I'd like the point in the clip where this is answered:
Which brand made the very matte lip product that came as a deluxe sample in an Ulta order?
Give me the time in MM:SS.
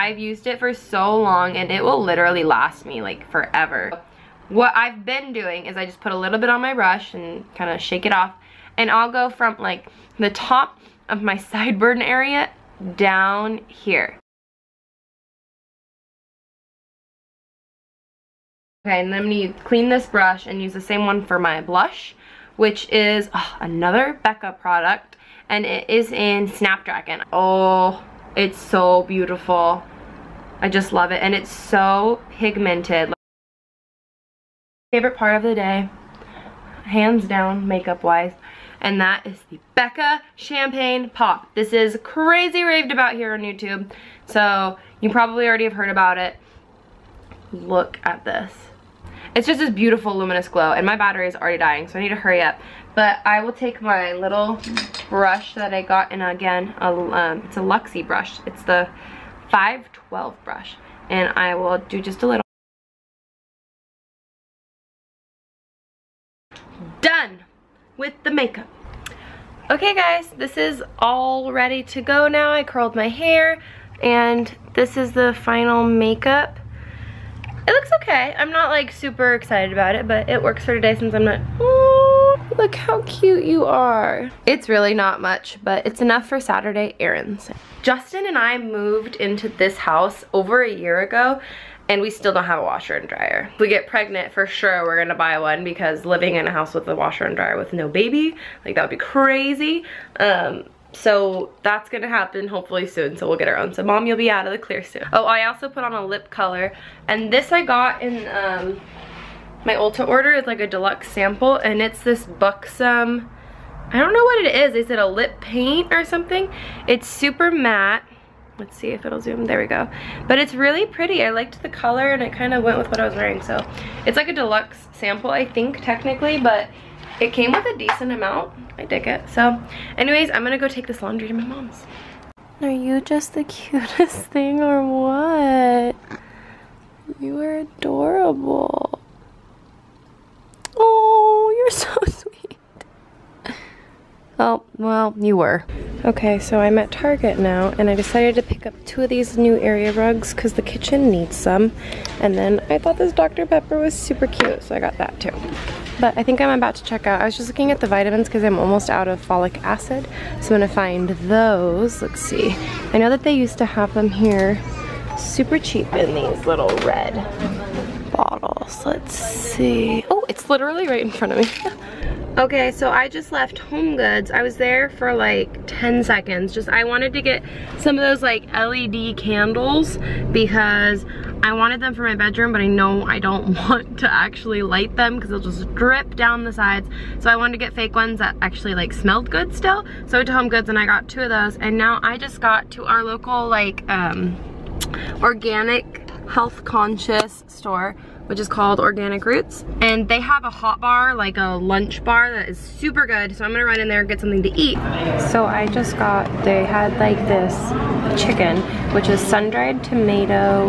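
01:52.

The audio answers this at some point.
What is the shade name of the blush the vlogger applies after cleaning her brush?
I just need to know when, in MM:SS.
00:26.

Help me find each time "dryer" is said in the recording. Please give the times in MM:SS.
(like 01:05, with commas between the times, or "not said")
01:33, 01:37.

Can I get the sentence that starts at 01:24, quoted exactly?
It's really not much, but it's enough for Saturday errands.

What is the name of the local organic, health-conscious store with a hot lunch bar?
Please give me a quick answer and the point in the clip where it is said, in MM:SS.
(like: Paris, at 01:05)
Organic Roots, at 03:18.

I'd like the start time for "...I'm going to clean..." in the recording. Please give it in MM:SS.
00:19.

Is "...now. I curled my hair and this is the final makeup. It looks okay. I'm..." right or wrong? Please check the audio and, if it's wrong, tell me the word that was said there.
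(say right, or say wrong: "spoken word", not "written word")
right.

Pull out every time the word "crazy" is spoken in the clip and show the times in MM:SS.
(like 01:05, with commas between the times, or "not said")
00:42, 01:38.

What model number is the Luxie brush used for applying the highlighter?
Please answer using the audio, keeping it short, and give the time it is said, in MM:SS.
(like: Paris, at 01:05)
512, at 00:59.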